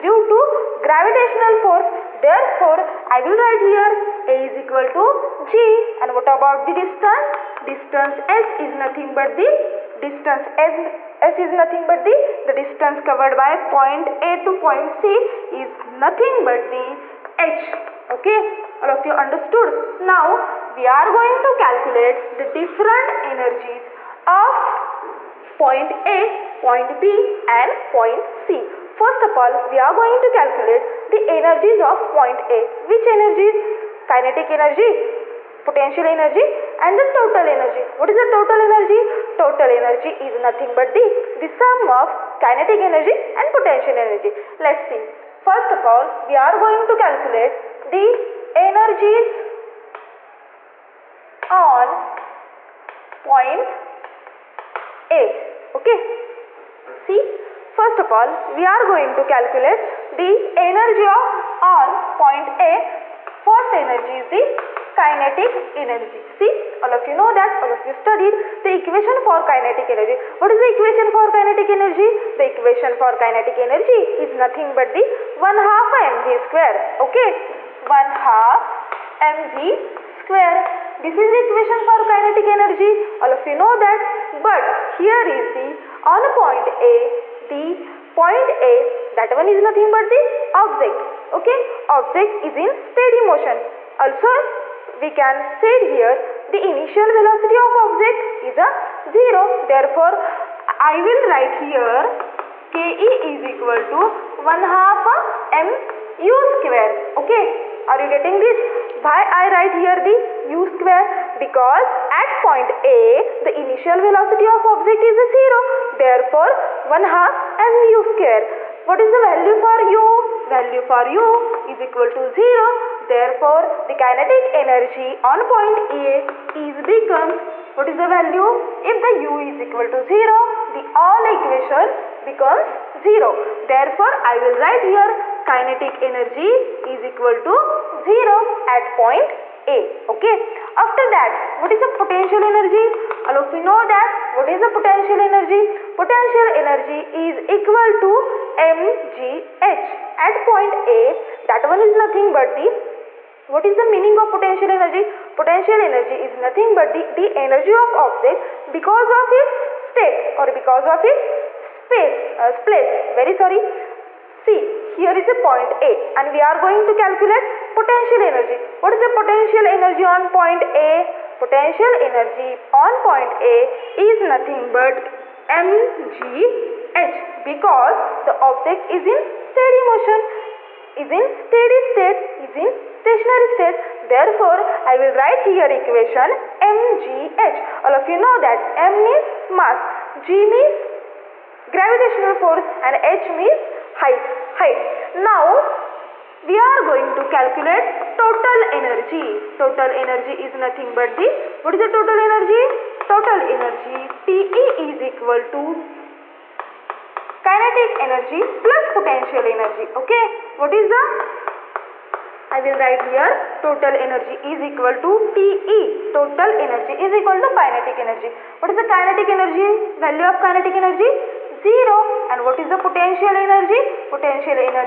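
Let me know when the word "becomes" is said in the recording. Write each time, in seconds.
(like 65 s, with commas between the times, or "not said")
126 s, 132 s.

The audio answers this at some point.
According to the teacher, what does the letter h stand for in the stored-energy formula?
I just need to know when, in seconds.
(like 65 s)
193 s.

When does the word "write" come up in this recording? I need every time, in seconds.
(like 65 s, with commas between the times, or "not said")
3 s, 101 s, 109 s, 134 s, 185 s, 212 s.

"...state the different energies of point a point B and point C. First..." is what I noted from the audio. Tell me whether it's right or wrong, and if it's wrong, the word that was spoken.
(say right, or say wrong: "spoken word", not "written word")
wrong: "calculate", not "state".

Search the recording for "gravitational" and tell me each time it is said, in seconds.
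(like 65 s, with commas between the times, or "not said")
0 s, 191 s.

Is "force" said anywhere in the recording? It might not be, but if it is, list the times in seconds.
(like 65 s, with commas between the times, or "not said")
1 s, 192 s.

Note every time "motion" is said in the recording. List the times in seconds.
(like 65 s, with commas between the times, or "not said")
93 s, 179 s.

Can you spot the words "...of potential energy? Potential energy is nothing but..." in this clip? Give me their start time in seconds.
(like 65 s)
154 s.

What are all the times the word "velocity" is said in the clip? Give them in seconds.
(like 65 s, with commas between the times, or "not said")
97 s, 114 s.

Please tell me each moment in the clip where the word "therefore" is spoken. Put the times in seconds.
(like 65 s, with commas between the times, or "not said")
2 s, 99 s, 116 s, 123 s, 133 s, 184 s.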